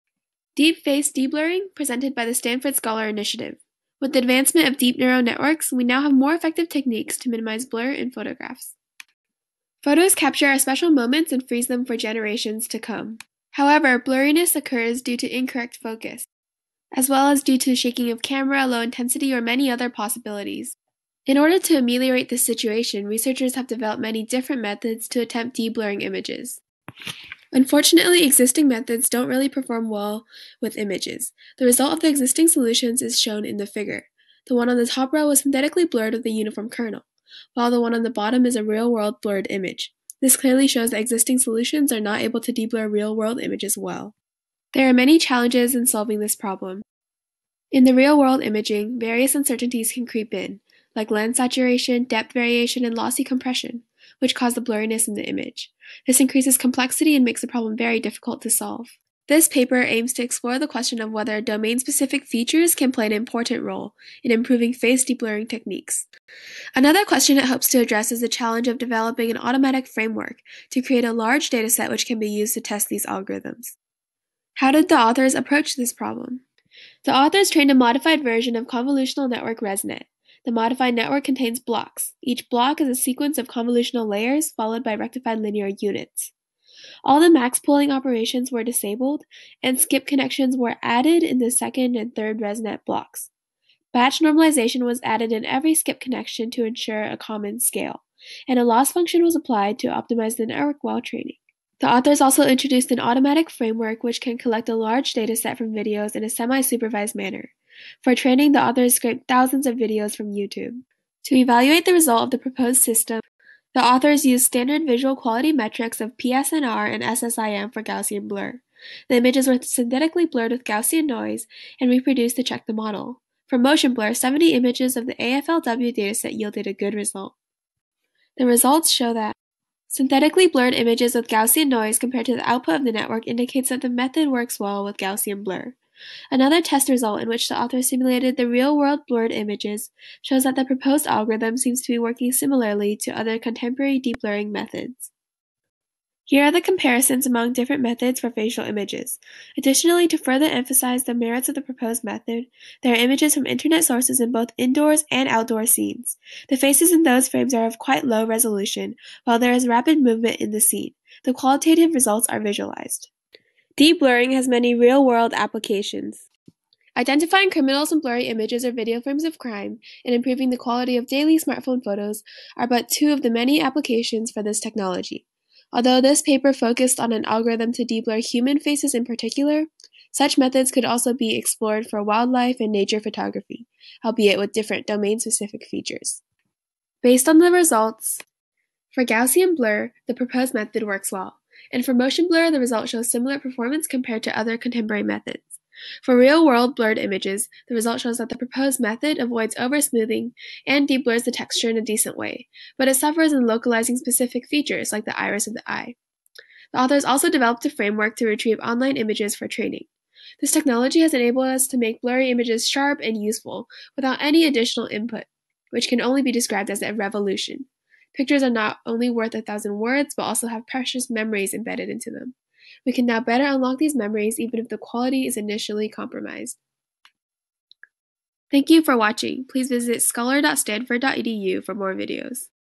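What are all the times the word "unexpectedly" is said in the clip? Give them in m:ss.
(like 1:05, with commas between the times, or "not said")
not said.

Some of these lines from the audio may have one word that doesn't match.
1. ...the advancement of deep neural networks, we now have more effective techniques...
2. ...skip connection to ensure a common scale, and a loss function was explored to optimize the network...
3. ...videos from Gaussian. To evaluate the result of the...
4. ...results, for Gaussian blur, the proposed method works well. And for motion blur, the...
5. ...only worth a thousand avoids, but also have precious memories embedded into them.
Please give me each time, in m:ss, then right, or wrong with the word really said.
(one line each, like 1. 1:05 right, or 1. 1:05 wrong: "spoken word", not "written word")
1. 0:04 right
2. 1:35 wrong: "applied", not "explored"
3. 1:49 wrong: "YouTube", not "Gaussian"
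4. 3:07 right
5. 3:38 wrong: "words", not "avoids".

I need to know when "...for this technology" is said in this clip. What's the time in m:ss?
2:54.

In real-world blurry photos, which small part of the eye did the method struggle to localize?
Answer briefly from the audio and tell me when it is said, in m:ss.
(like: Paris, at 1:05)
Iris, at 3:25.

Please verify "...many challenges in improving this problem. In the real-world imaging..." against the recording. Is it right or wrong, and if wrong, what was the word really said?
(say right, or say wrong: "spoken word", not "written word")
wrong: "solving", not "improving".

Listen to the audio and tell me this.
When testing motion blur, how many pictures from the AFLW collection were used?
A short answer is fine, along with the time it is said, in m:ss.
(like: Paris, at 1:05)
70, at 2:04.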